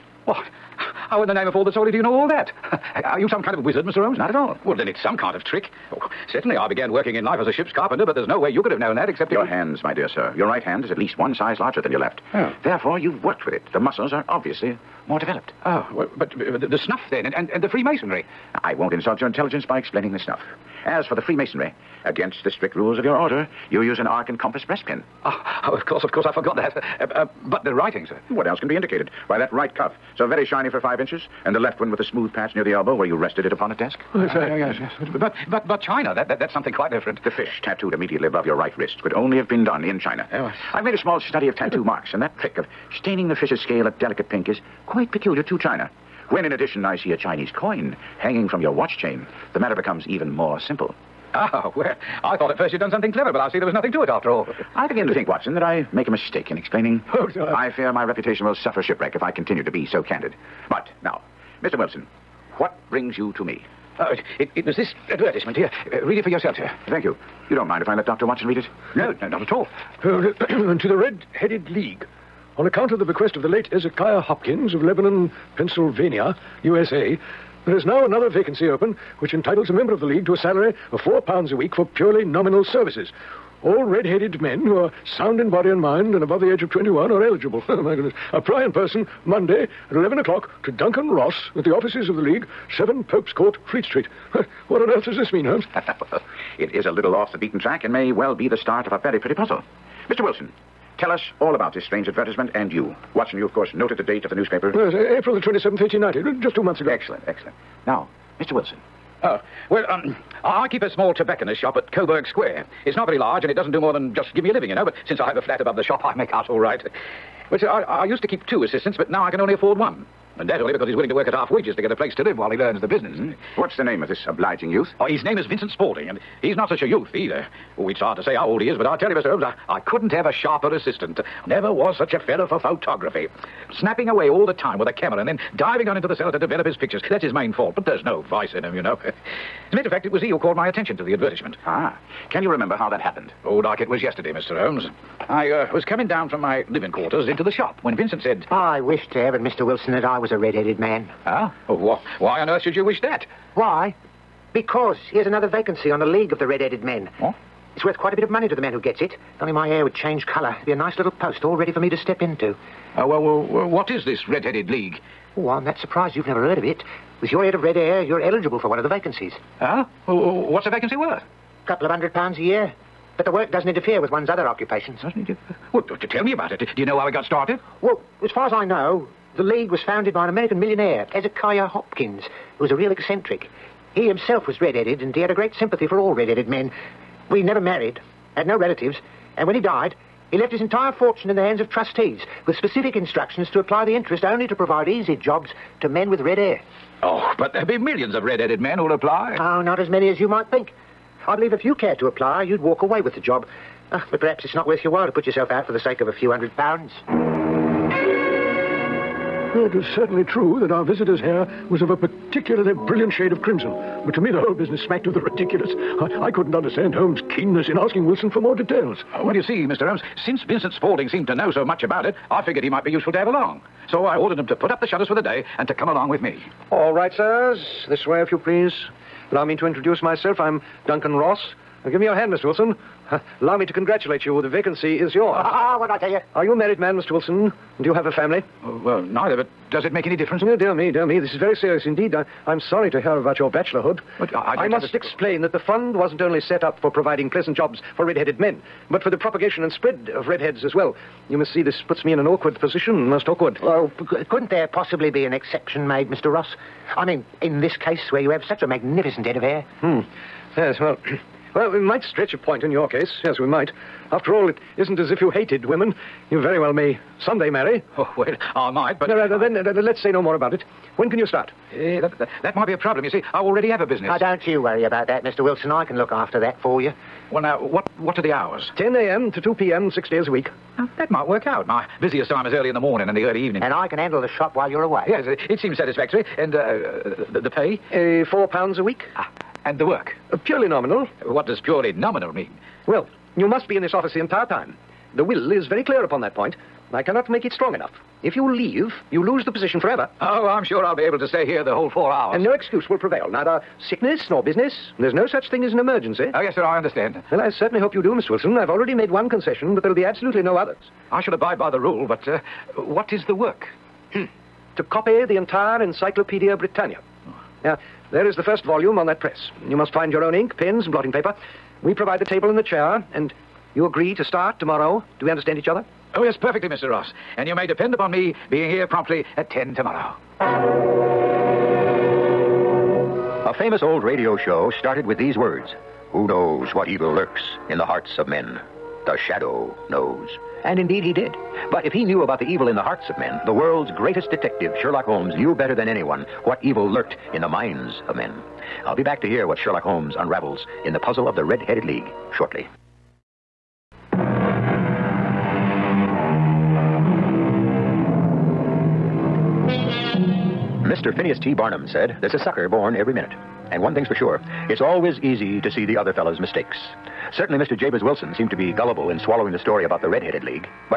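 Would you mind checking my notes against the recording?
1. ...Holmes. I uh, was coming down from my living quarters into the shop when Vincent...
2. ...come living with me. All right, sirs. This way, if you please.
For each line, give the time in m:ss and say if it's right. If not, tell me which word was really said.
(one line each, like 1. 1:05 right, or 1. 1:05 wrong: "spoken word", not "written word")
1. 2:24 right
2. 3:45 wrong: "along", not "living".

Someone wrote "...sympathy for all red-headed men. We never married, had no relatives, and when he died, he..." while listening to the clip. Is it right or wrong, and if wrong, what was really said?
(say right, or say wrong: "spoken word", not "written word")
right.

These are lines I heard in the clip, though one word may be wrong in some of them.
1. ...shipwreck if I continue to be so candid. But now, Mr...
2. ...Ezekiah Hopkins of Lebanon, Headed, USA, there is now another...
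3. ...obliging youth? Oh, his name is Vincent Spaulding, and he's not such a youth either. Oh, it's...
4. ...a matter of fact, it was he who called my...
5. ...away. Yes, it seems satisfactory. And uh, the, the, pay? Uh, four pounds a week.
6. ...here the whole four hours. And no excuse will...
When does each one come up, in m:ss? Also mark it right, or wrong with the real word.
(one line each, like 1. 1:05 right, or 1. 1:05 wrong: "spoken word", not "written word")
1. 0:58 right
2. 1:13 wrong: "Pennsylvania", not "Headed"
3. 2:04 right
4. 2:19 right
5. 4:44 right
6. 5:01 right.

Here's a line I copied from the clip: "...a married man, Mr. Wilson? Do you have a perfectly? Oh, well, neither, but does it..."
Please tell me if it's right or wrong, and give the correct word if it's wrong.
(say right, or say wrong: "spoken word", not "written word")
wrong: "family", not "perfectly".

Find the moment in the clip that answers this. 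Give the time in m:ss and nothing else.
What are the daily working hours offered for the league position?
4:38.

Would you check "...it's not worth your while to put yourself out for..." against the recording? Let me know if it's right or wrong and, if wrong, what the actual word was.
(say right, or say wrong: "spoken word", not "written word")
right.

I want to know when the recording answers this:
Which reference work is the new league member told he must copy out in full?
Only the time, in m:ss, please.
5:15.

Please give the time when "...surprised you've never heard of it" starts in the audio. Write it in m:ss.
2:45.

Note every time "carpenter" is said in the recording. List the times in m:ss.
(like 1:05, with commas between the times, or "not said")
0:07.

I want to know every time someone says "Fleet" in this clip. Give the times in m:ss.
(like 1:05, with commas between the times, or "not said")
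1:33.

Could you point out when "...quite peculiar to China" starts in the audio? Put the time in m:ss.
0:44.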